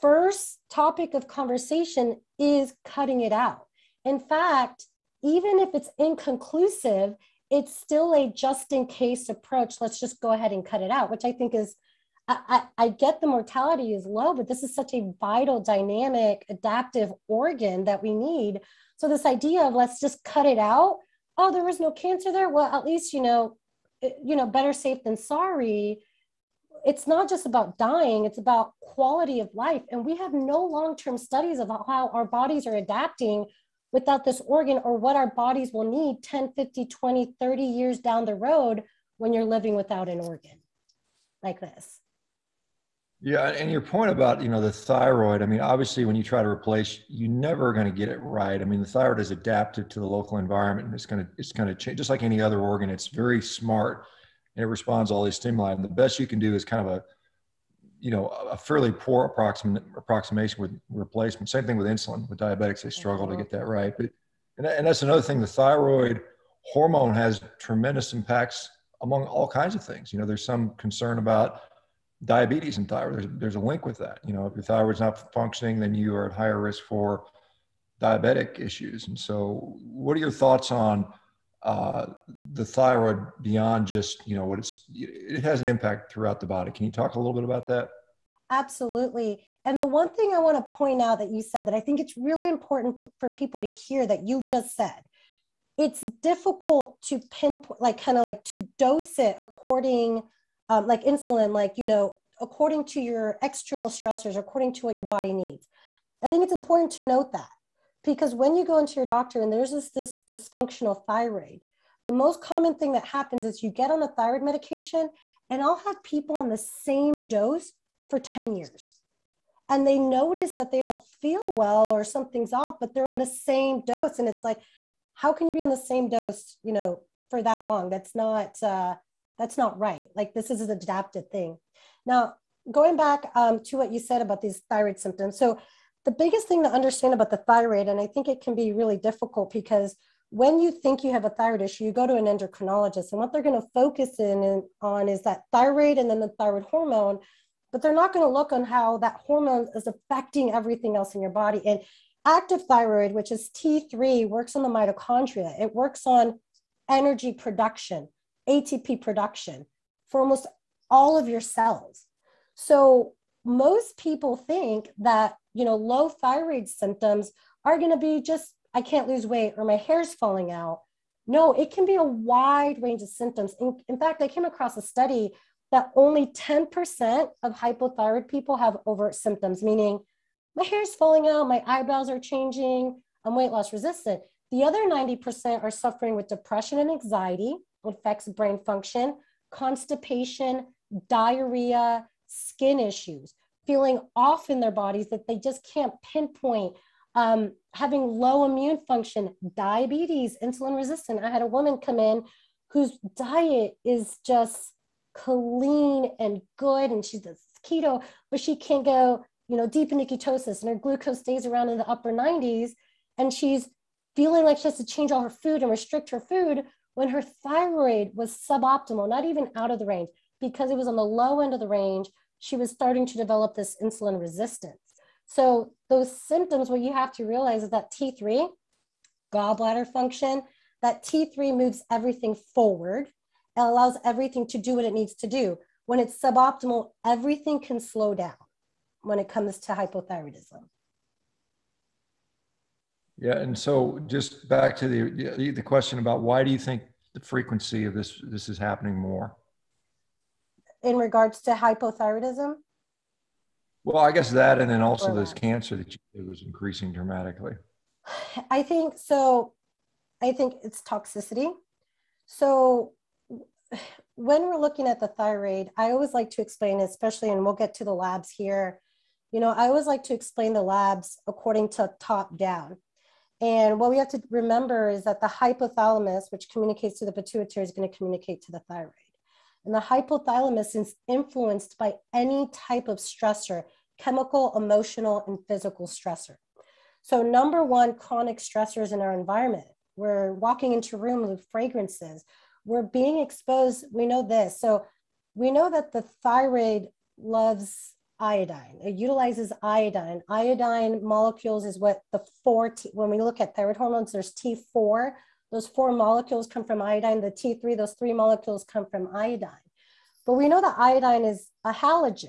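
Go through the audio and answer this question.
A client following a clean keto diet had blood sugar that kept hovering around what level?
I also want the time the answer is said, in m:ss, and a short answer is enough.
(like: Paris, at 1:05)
upper 90s, at 3:31.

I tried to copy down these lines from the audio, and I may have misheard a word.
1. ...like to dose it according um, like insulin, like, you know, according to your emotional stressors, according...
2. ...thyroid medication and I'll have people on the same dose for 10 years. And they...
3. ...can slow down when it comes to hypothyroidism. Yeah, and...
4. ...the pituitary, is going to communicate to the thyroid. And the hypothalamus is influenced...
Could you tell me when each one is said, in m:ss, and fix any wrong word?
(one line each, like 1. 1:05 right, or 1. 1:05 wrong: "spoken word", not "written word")
1. 1:38 wrong: "external", not "emotional"
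2. 1:54 right
3. 3:57 right
4. 4:37 right.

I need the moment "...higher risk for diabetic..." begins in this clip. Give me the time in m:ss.
1:16.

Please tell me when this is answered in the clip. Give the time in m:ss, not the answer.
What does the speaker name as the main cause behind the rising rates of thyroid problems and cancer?
4:20.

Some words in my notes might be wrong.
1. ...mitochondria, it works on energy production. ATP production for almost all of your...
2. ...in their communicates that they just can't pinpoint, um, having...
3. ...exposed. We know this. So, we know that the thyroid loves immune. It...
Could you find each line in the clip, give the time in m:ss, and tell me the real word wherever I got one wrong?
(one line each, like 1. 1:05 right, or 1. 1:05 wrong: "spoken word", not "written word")
1. 2:34 right
2. 3:14 wrong: "bodies", not "communicates"
3. 4:53 wrong: "iodine", not "immune".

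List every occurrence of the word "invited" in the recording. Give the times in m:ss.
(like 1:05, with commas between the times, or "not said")
not said.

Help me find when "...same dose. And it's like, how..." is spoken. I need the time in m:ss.
2:03.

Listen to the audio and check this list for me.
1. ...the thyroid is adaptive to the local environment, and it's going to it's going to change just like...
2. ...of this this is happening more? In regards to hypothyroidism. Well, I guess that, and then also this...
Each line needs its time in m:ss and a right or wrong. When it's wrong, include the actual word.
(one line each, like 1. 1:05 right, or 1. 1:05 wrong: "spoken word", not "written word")
1. 0:48 right
2. 4:07 right.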